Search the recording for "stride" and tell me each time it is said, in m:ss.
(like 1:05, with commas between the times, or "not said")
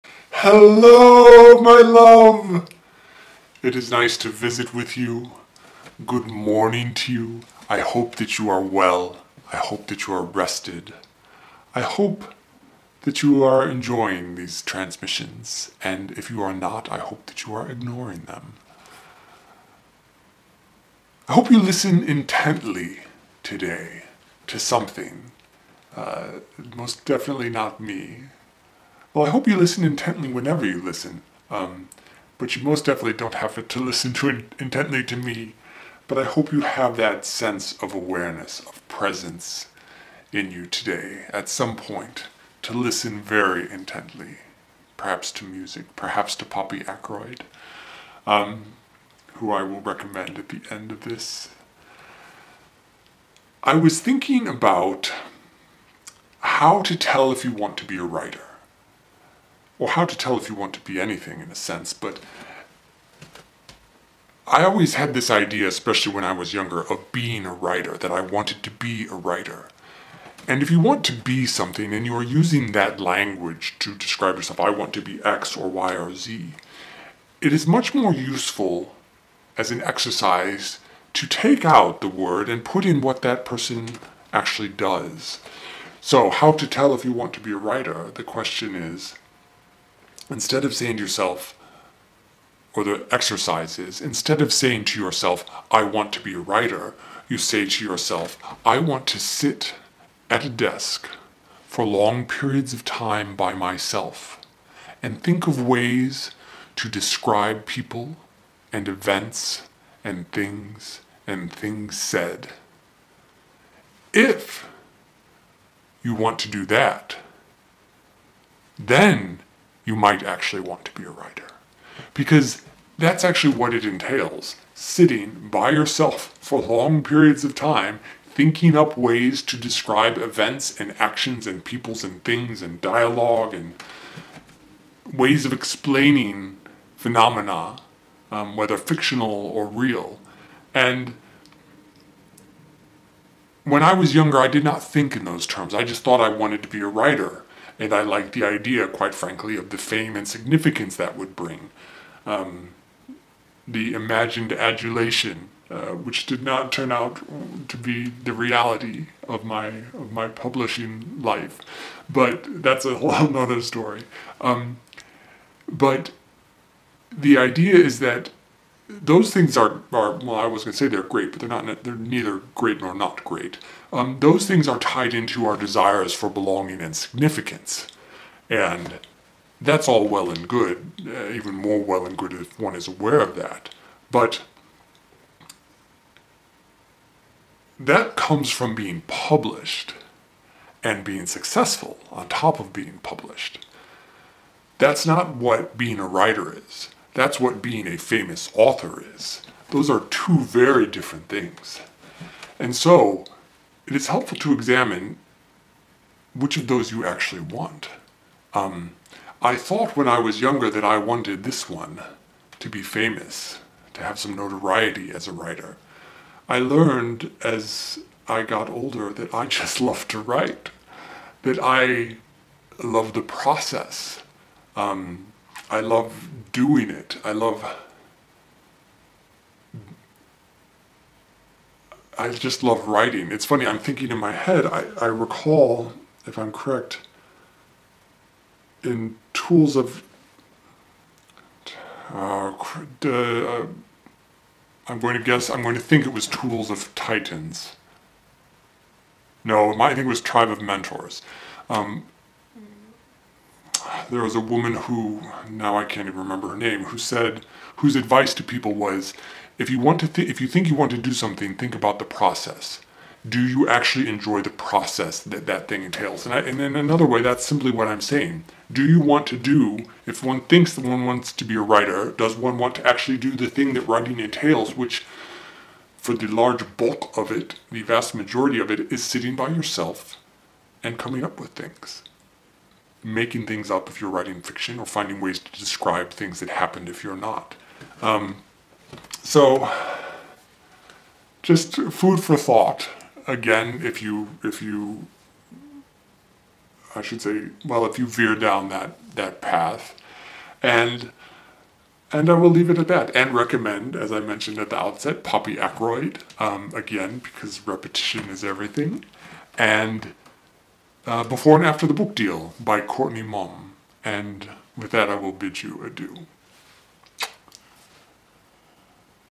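not said.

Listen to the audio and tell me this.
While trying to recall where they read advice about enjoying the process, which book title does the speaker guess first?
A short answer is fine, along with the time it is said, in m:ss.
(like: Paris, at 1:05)
Tools of Titans, at 4:06.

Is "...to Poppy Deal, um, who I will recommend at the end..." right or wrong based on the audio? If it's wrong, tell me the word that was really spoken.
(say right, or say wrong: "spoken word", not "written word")
wrong: "Ackroyd", not "Deal".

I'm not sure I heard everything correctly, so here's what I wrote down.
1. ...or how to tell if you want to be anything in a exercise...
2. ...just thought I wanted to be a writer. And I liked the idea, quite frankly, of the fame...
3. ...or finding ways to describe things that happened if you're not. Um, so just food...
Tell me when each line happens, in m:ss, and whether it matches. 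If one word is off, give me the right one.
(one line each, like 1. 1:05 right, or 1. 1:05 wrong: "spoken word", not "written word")
1. 0:59 wrong: "sense", not "exercise"
2. 2:25 right
3. 4:44 right.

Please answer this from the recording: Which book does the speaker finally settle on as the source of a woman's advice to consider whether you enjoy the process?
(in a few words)
Tribe of Mentors.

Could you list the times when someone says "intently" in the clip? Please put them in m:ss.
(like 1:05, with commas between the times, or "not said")
0:22, 0:29, 0:34, 0:43.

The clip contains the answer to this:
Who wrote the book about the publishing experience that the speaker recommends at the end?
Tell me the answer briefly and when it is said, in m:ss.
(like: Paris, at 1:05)
Courtney Maum, at 5:12.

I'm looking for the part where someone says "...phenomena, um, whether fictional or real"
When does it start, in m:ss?
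2:16.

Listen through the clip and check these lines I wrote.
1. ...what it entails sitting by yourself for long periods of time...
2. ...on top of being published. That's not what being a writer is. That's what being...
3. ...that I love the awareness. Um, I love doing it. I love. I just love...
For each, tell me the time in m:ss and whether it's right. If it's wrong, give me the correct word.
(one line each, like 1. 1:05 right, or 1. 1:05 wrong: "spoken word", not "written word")
1. 2:03 right
2. 3:12 right
3. 3:41 wrong: "process", not "awareness".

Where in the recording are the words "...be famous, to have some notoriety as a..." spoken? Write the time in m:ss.
3:32.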